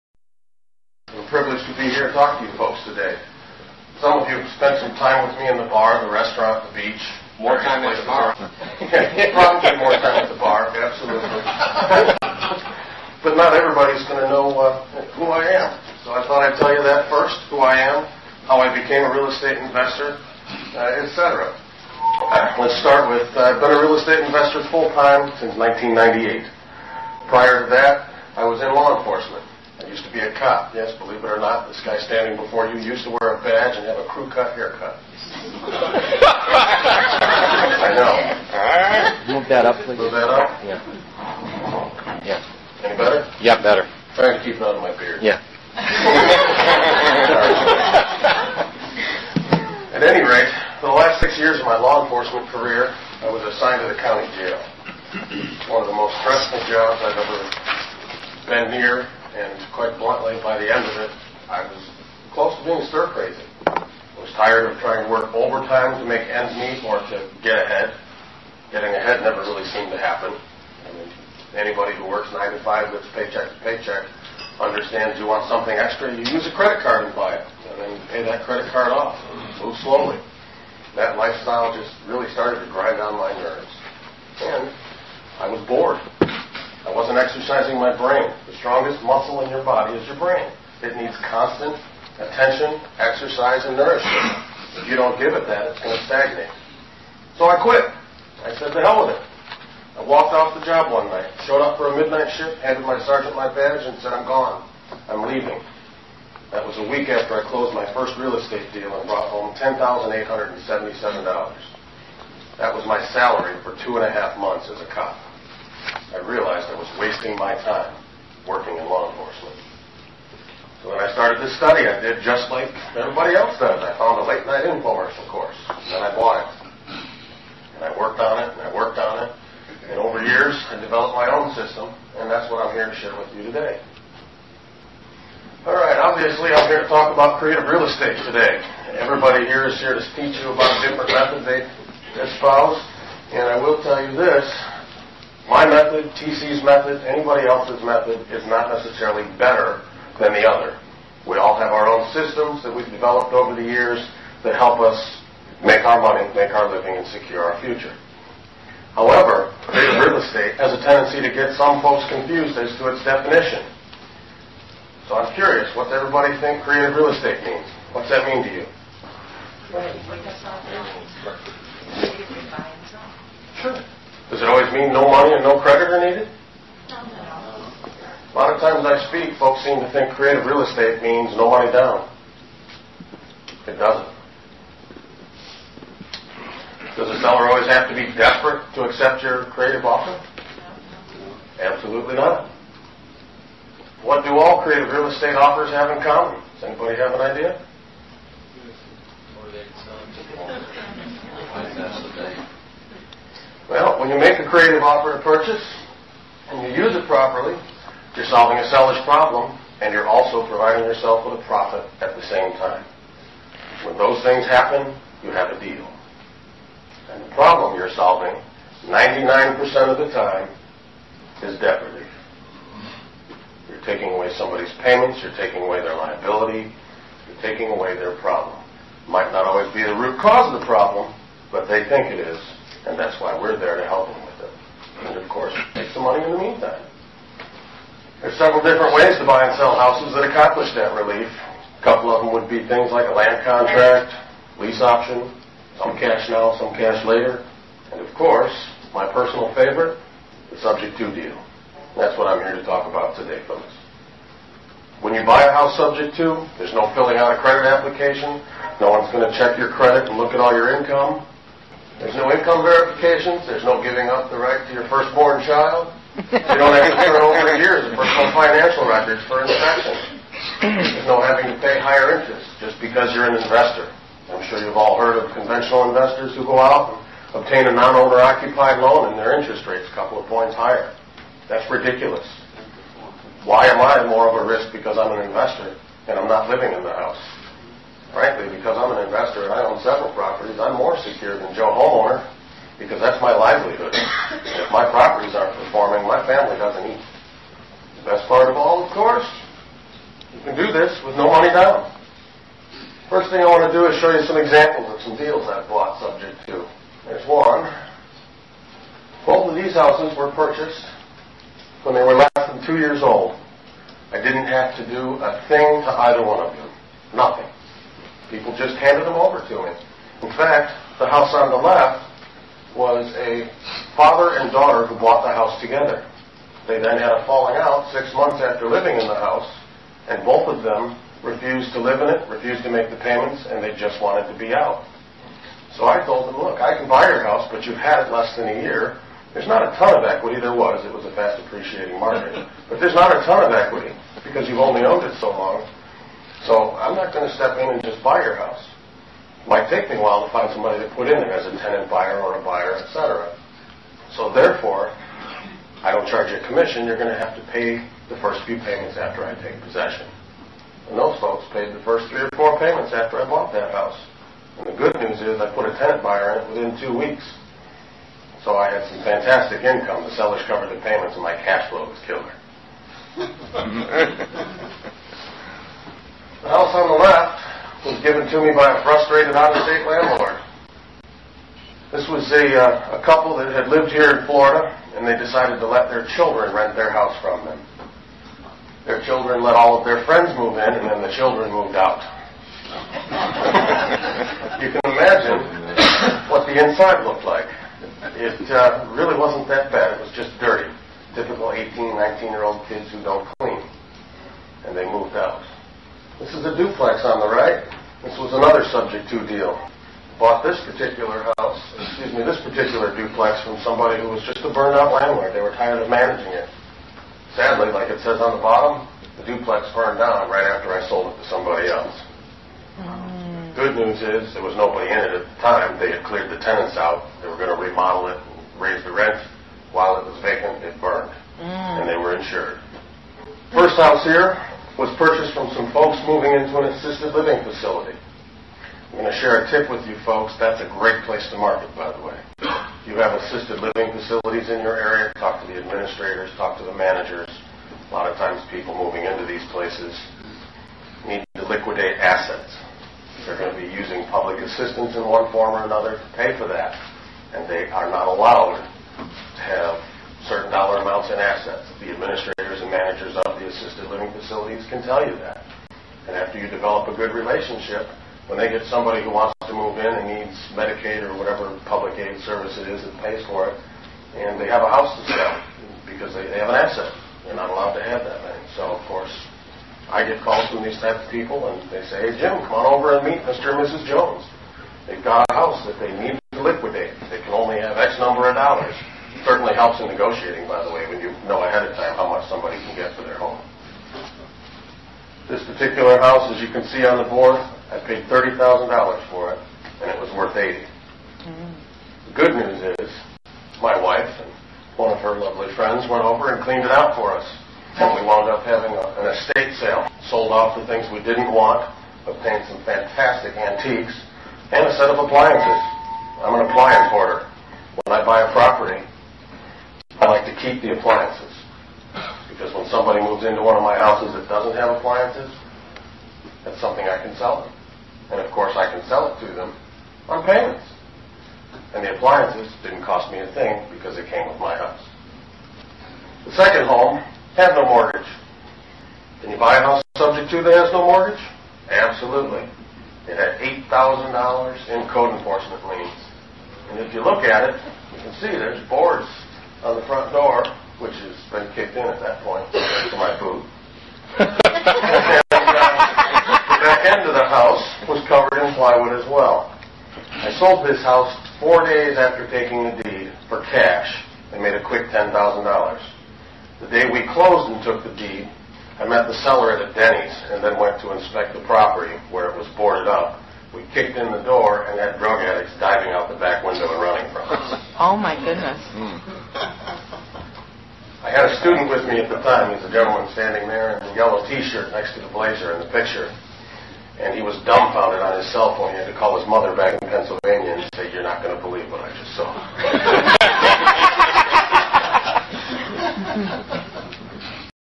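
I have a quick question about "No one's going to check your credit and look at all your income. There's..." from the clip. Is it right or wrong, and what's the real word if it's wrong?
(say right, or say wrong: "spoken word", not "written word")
right.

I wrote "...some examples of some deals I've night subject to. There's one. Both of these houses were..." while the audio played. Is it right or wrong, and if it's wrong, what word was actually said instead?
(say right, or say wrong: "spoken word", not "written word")
wrong: "bought", not "night".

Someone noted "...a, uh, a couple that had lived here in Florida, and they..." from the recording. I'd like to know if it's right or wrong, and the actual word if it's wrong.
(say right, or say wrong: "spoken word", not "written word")
right.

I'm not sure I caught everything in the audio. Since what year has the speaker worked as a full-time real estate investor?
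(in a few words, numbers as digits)
1998.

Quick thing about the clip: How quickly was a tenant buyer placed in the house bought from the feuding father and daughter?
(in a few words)
within two weeks.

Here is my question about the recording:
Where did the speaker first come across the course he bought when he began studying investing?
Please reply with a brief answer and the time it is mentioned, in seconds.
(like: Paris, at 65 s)
late night infomercial, at 124 s.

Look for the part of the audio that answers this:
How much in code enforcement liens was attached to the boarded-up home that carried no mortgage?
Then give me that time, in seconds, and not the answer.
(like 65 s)
543 s.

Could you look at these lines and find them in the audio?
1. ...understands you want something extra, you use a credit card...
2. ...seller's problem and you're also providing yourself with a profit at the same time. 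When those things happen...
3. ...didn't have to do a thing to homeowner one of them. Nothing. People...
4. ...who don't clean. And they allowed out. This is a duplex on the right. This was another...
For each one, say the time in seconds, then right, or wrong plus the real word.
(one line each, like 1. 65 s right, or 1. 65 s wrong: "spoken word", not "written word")
1. 74 s right
2. 208 s right
3. 314 s wrong: "either", not "homeowner"
4. 402 s wrong: "moved", not "allowed".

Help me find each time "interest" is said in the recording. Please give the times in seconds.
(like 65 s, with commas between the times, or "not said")
272 s, 279 s.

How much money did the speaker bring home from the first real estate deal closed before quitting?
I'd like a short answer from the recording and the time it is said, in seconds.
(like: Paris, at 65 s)
$10,877, at 109 s.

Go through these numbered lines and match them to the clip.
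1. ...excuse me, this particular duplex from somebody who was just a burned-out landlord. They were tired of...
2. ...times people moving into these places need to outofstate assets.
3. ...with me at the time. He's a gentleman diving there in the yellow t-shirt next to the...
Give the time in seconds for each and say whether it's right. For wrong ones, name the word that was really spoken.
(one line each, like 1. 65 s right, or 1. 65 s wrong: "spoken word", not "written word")
1. 411 s right
2. 448 s wrong: "liquidate", not "outofstate"
3. 581 s wrong: "standing", not "diving".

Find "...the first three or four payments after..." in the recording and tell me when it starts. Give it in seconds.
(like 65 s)
361 s.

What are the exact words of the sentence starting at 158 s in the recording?
However, real estate has a tendency to get some folks confused as to its definition.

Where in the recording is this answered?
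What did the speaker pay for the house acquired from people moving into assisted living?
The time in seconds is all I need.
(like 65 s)
498 s.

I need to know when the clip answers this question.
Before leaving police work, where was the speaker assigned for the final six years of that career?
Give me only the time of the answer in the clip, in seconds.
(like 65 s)
53 s.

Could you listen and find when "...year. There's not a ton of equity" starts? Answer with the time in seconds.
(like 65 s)
338 s.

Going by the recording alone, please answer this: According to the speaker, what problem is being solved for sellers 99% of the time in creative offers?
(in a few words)
debt relief.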